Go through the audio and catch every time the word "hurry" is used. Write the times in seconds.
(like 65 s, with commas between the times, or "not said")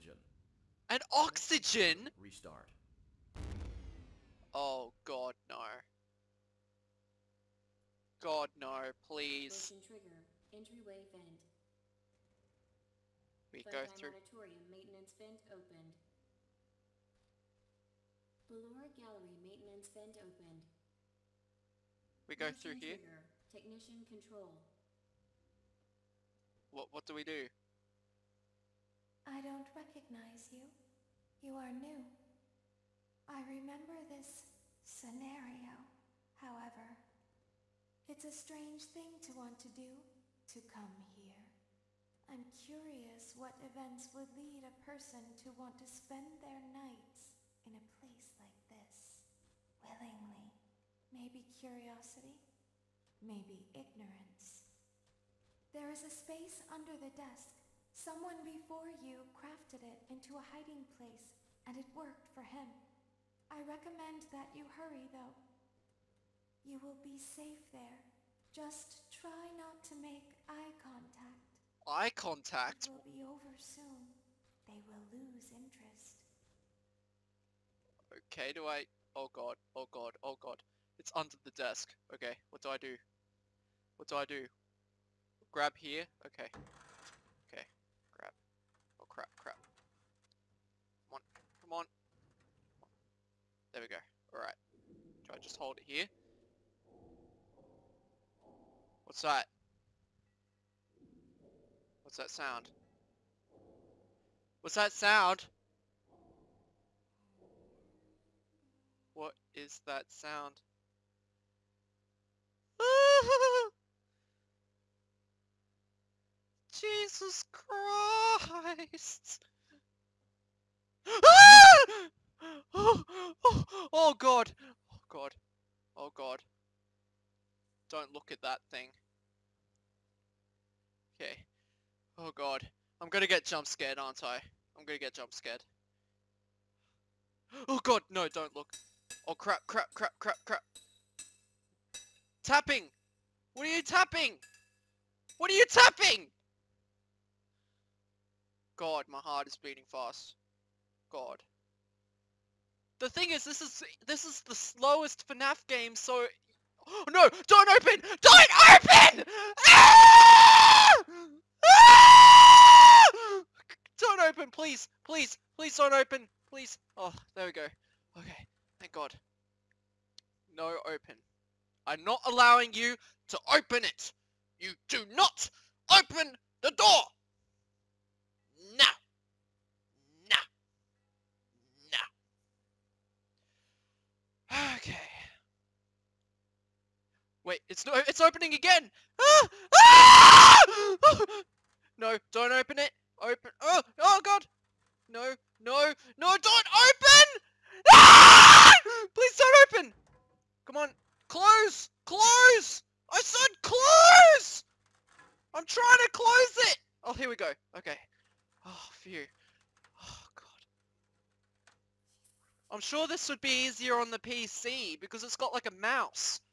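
64 s.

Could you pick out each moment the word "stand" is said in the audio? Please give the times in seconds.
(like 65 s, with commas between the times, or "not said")
not said.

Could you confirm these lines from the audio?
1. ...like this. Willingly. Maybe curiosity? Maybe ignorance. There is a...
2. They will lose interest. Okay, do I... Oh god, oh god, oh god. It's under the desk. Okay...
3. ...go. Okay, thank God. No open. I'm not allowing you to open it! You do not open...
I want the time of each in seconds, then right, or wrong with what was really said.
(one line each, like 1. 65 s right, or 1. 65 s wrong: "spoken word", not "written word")
1. 48 s right
2. 74 s right
3. 167 s right.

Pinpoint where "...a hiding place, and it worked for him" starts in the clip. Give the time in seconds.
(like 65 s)
60 s.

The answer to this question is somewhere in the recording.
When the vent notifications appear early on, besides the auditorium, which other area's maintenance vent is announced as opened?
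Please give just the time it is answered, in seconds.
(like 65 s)
18 s.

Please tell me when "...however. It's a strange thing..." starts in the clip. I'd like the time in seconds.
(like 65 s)
36 s.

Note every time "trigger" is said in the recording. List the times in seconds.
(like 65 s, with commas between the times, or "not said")
9 s, 22 s.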